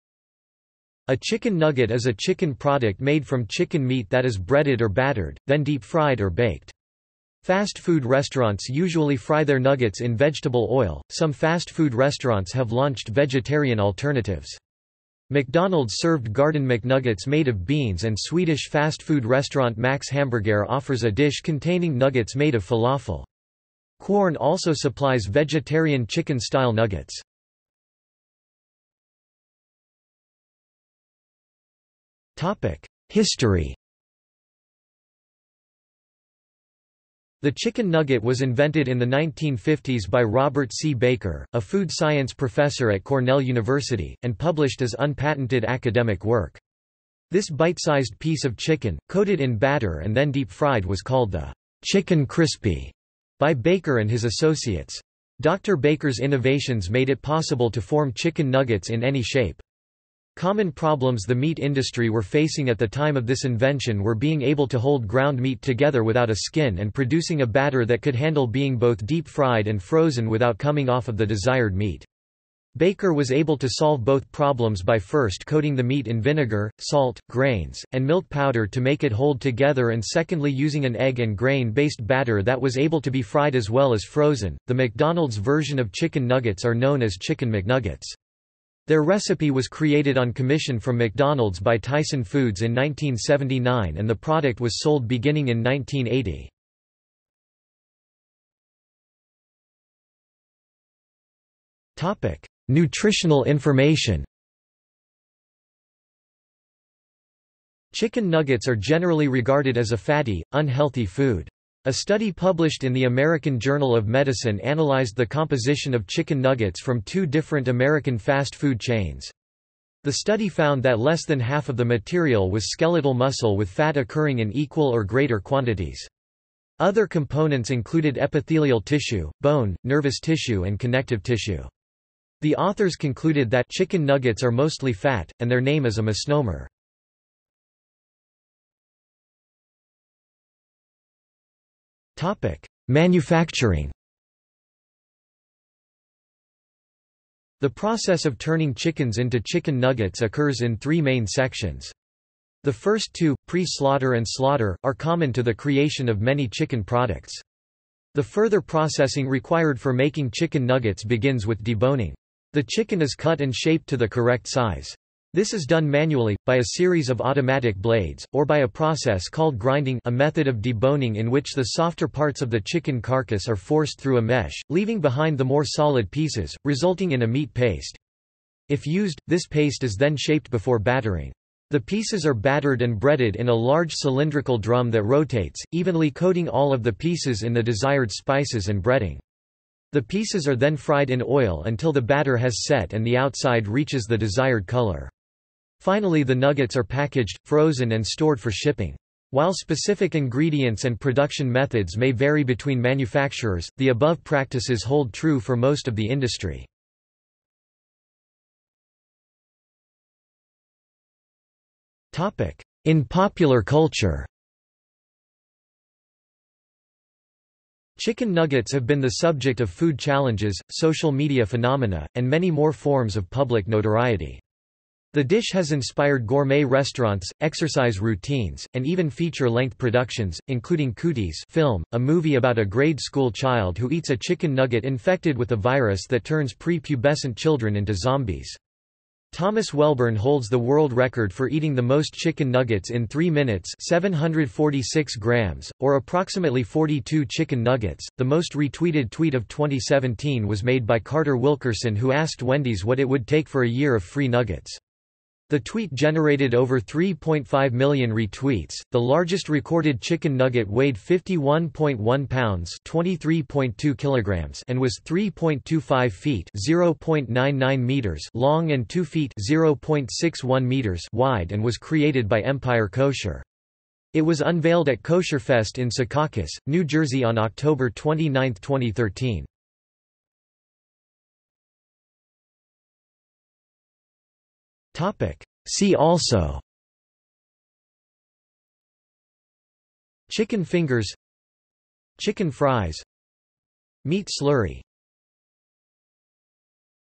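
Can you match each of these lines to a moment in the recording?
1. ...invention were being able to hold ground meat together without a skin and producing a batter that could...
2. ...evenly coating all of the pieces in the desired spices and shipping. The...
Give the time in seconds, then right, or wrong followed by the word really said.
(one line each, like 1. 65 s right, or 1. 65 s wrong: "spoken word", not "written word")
1. 63 s right
2. 185 s wrong: "breading", not "shipping".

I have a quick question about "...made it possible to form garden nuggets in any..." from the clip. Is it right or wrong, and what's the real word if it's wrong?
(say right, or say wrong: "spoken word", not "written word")
wrong: "chicken", not "garden".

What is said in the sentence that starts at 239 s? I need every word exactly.
Thomas Welburn holds the world record for eating the most chicken nuggets in 3 minutes 746 grams, or approximately 42 chicken nuggets.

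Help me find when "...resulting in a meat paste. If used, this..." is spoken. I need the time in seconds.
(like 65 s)
176 s.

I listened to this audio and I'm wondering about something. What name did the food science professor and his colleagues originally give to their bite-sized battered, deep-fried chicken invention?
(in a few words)
chicken crispy.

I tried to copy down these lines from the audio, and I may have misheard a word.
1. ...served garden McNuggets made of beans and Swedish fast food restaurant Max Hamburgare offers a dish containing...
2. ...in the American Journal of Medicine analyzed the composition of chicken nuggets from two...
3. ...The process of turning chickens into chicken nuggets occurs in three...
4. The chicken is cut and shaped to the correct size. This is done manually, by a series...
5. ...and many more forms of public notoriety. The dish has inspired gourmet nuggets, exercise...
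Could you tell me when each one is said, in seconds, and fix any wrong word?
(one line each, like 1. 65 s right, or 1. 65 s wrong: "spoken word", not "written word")
1. 15 s right
2. 112 s right
3. 147 s right
4. 162 s right
5. 222 s wrong: "restaurants", not "nuggets".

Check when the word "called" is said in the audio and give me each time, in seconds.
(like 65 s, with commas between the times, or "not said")
51 s, 169 s.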